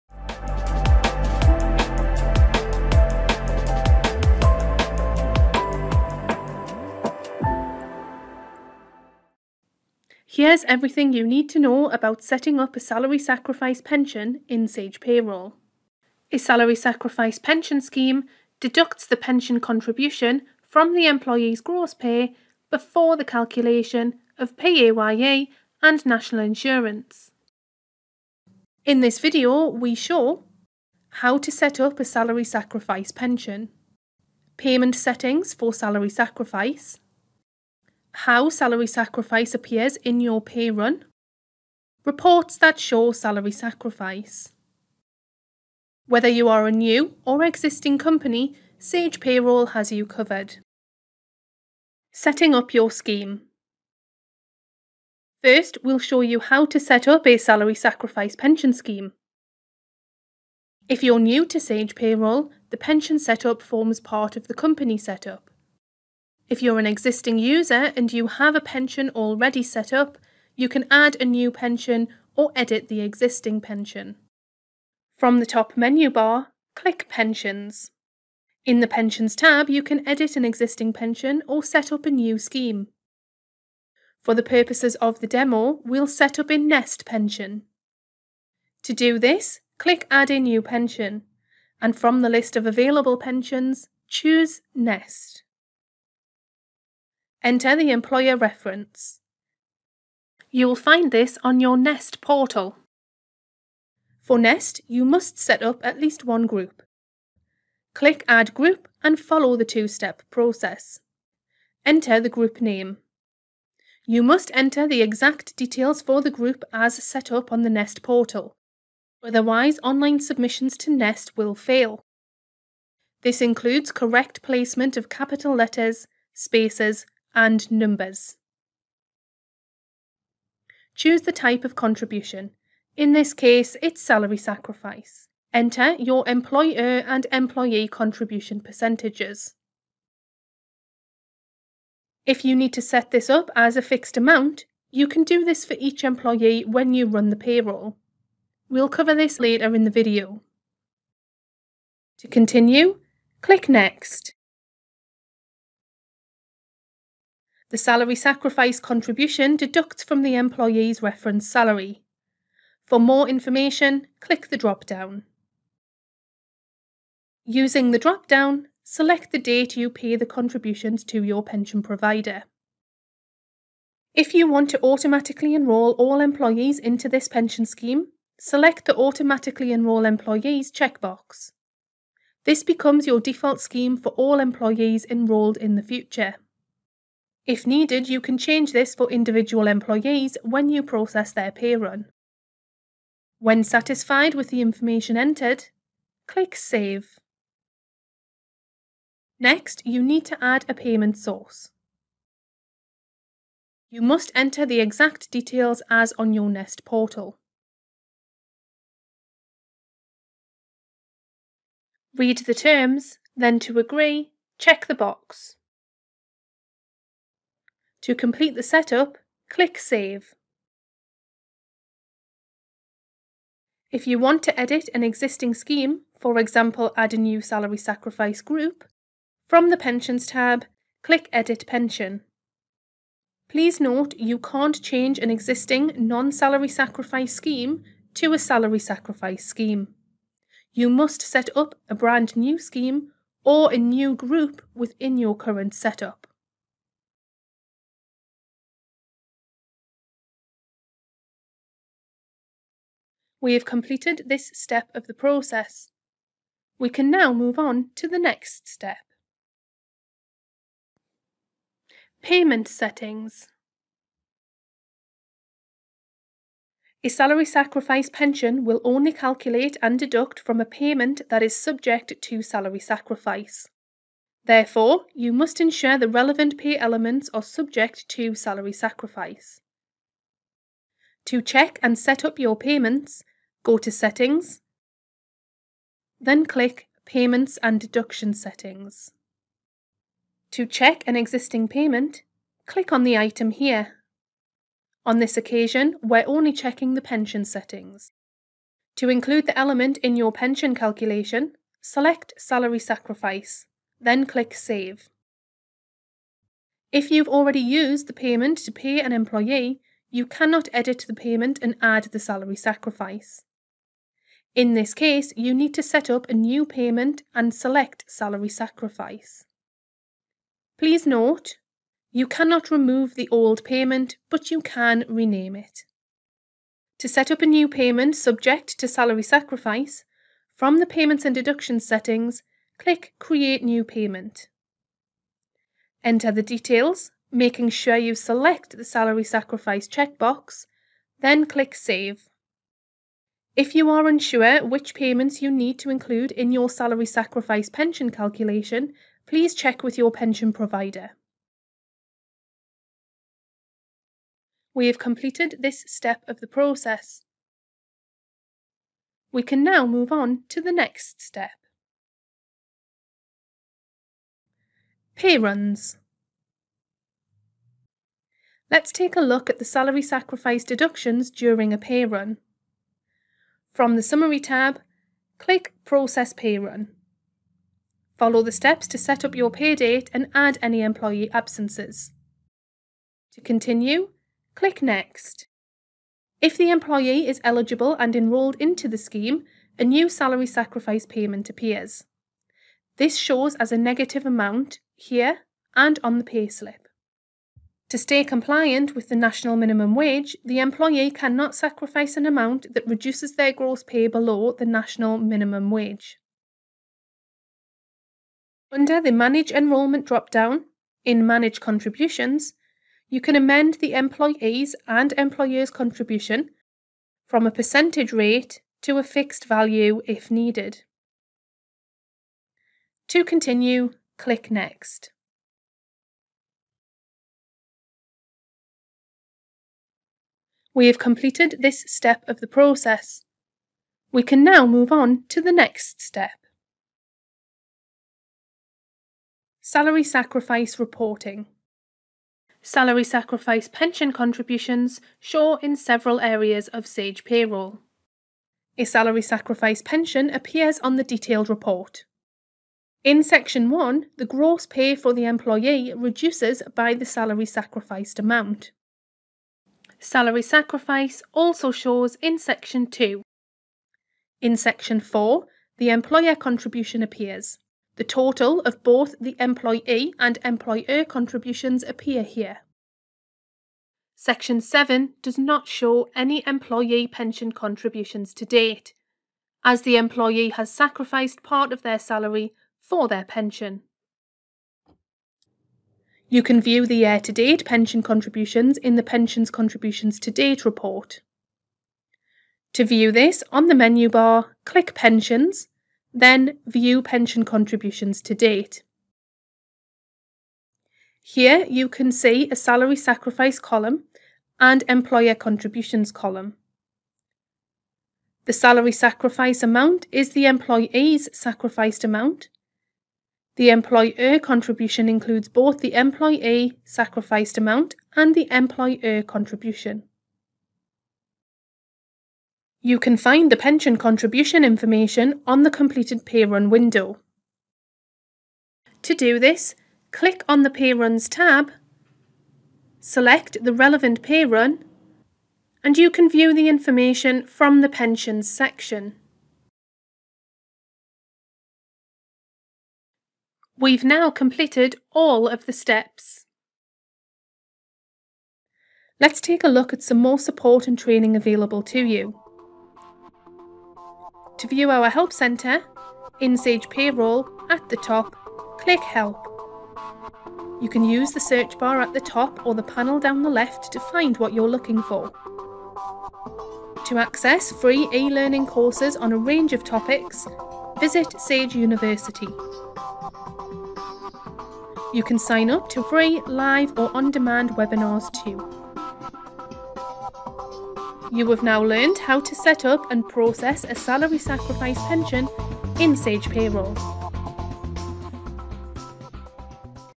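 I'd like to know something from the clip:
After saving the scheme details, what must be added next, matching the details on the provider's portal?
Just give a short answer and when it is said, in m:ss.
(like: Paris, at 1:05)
a payment source, at 3:20.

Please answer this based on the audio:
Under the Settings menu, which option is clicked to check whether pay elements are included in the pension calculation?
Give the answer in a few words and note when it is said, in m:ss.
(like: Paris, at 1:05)
Payments and Deduction Settings, at 4:47.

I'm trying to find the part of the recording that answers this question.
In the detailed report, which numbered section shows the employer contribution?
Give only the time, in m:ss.
7:44.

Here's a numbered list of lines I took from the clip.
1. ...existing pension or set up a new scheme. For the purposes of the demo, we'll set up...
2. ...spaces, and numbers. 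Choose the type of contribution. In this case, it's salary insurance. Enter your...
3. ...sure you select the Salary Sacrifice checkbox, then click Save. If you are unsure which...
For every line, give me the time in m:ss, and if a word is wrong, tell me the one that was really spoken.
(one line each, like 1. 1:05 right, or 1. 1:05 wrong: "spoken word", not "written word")
1. 1:20 right
2. 2:06 wrong: "sacrifice", not "insurance"
3. 5:37 right.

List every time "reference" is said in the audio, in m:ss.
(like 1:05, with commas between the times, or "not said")
1:38, 2:41.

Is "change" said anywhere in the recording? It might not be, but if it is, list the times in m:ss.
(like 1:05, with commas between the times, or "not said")
3:08, 3:54.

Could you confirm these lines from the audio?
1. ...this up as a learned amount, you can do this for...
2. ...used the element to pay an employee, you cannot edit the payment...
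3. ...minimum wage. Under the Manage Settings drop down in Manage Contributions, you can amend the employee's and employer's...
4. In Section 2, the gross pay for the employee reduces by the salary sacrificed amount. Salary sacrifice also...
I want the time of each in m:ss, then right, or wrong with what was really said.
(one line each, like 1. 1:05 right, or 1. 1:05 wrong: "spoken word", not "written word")
1. 2:23 wrong: "fixed", not "learned"
2. 5:07 wrong: "payment", not "element"
3. 6:45 wrong: "Enrolment", not "Settings"
4. 7:33 wrong: "1", not "2".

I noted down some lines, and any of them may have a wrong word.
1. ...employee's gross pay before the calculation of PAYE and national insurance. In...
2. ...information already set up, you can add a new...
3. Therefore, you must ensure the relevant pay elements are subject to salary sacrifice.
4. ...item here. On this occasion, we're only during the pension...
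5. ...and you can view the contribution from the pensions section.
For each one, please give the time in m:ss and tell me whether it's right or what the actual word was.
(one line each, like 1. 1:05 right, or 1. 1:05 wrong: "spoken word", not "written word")
1. 0:21 right
2. 1:08 wrong: "pension", not "information"
3. 4:34 right
4. 4:53 wrong: "checking", not "during"
5. 8:55 wrong: "information", not "contribution".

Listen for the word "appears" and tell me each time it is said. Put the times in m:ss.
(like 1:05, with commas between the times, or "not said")
0:39, 6:31, 7:30, 7:47, 7:51.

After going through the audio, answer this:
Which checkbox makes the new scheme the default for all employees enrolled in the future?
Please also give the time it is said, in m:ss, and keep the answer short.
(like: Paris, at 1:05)
Automatically Enrol Employees, at 2:58.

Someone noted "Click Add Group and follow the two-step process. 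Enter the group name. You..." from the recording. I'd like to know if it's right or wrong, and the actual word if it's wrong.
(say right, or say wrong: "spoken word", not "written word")
right.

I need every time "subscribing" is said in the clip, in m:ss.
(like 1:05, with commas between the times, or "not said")
not said.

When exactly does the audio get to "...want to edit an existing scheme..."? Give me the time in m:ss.
3:44.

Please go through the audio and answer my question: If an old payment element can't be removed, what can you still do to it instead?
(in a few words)
rename it.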